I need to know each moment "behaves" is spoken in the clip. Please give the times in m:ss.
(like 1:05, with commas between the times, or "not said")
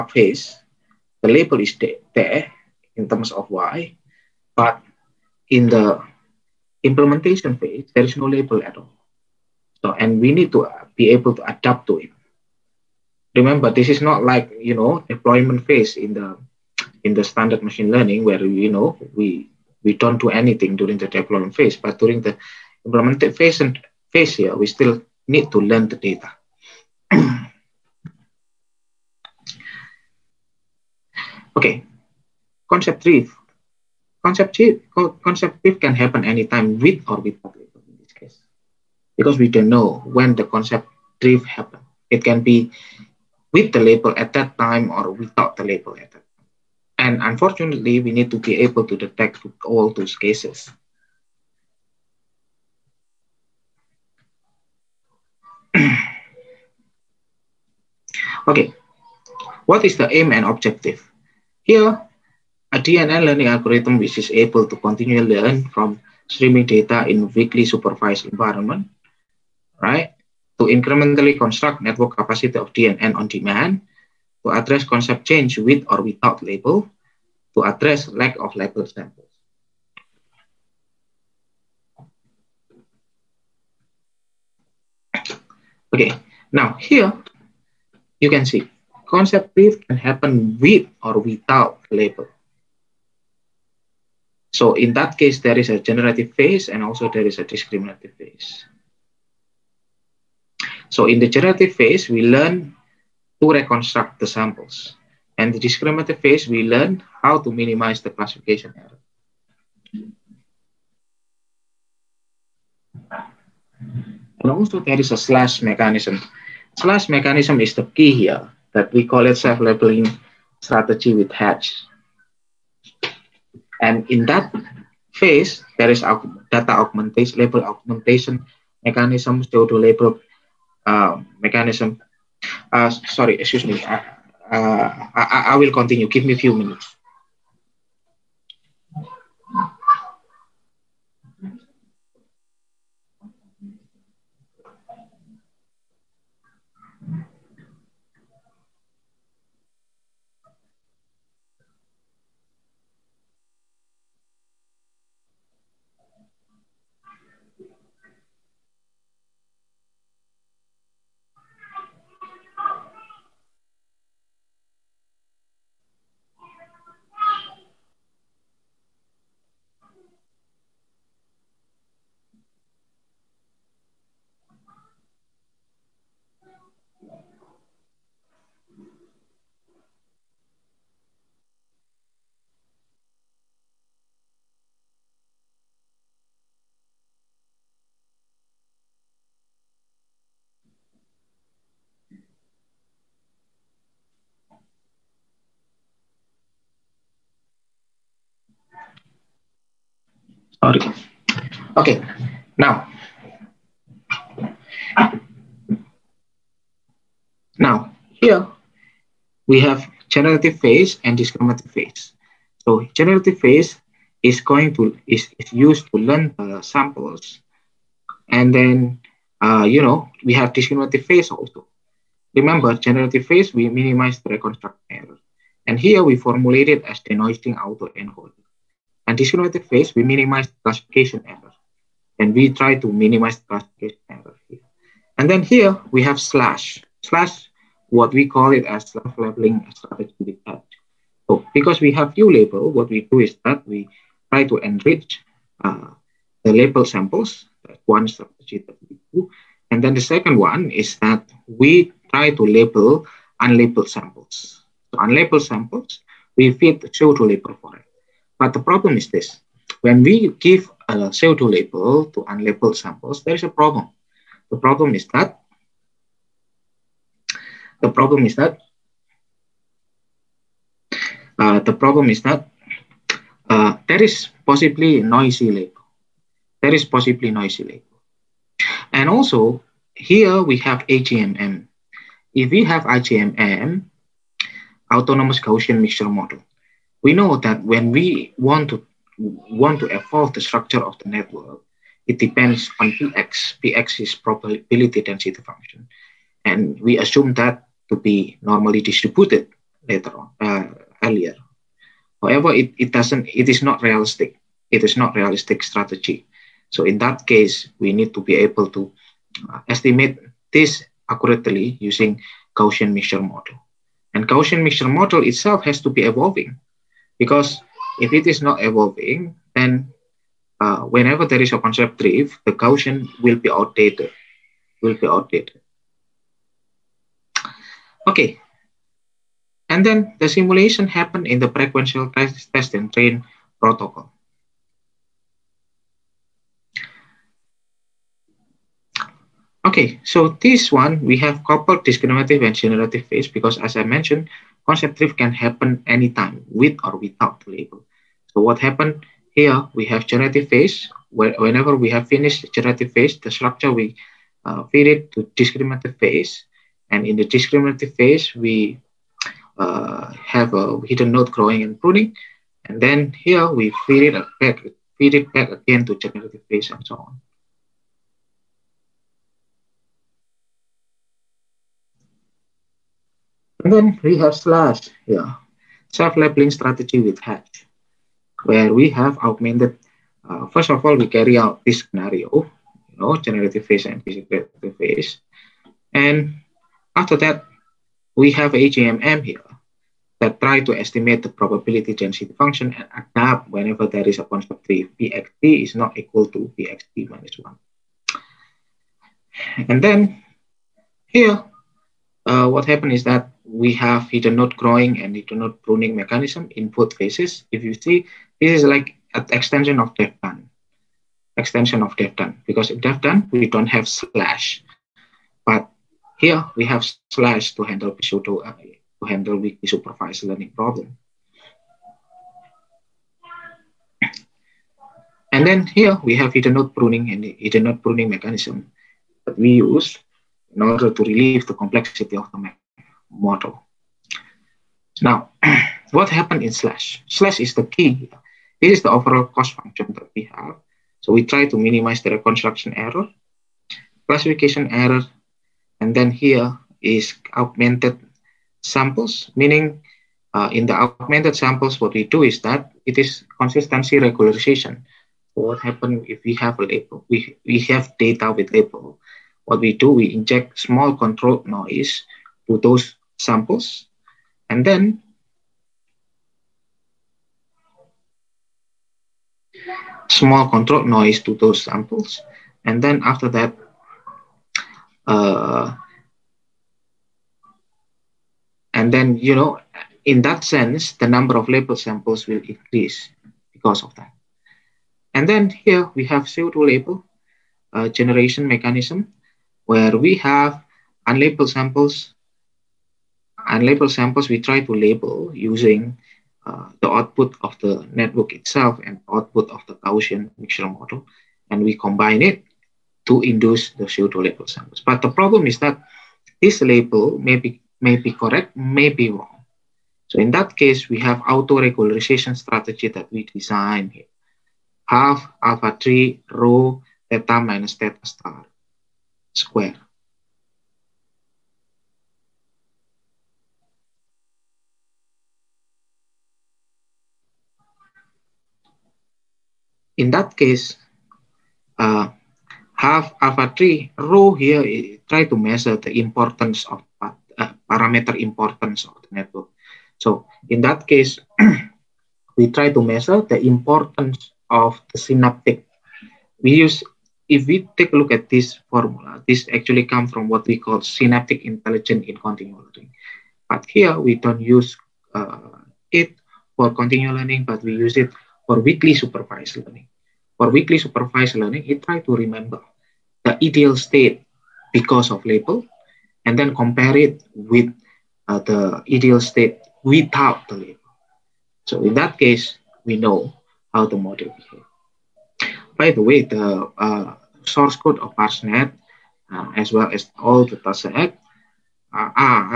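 9:34.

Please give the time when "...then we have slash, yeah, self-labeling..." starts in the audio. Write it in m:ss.
6:13.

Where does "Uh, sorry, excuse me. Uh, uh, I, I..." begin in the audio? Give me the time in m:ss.
2:12.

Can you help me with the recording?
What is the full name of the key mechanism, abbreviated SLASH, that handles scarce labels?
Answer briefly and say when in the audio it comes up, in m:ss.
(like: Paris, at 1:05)
self-labeling strategy with hatch, at 1:59.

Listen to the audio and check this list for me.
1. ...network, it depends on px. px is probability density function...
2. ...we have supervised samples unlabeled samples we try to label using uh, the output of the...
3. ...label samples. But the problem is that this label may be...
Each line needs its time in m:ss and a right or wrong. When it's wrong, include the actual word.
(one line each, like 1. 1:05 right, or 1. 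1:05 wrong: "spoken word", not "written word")
1. 4:51 right
2. 8:09 wrong: "unlabeled", not "supervised"
3. 8:24 right.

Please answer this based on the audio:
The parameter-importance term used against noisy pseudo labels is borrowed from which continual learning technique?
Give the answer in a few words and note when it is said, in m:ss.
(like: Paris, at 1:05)
synaptic intelligence, at 9:10.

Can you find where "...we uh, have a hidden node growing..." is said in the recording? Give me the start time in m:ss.
5:58.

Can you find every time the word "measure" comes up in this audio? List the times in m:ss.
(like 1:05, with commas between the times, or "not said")
8:55, 9:02.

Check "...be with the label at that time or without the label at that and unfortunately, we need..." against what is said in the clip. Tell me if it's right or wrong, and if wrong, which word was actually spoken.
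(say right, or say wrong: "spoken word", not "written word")
right.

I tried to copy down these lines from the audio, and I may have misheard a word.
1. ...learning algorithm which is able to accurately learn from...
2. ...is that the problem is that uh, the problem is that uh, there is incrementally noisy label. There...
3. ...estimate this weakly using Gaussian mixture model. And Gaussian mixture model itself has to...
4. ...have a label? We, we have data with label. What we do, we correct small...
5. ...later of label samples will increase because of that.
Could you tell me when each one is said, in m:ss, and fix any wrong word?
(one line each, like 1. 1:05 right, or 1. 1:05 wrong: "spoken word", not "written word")
1. 1:03 wrong: "continually", not "accurately"
2. 4:24 wrong: "possibly", not "incrementally"
3. 5:09 wrong: "accurately", not "weakly"
4. 7:36 wrong: "inject", not "correct"
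5. 8:01 wrong: "number", not "later".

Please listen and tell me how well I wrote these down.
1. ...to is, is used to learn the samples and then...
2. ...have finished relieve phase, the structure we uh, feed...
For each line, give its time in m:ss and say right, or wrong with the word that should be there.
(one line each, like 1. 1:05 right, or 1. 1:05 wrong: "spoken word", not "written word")
1. 3:34 right
2. 5:51 wrong: "generative", not "relieve".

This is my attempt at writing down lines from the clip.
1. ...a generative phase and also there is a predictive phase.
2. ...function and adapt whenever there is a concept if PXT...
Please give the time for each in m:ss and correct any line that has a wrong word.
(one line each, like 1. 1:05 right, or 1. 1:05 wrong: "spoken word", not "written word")
1. 1:35 wrong: "discriminative", not "predictive"
2. 6:32 right.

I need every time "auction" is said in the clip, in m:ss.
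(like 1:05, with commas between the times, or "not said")
not said.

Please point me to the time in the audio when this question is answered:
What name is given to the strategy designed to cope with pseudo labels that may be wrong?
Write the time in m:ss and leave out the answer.
8:31.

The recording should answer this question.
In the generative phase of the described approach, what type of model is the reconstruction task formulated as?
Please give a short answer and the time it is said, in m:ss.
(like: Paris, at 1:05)
denoising auto encoder, at 3:47.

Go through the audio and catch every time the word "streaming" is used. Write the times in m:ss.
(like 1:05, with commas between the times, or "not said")
1:06.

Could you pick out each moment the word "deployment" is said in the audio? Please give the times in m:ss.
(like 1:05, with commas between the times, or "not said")
0:15, 0:21.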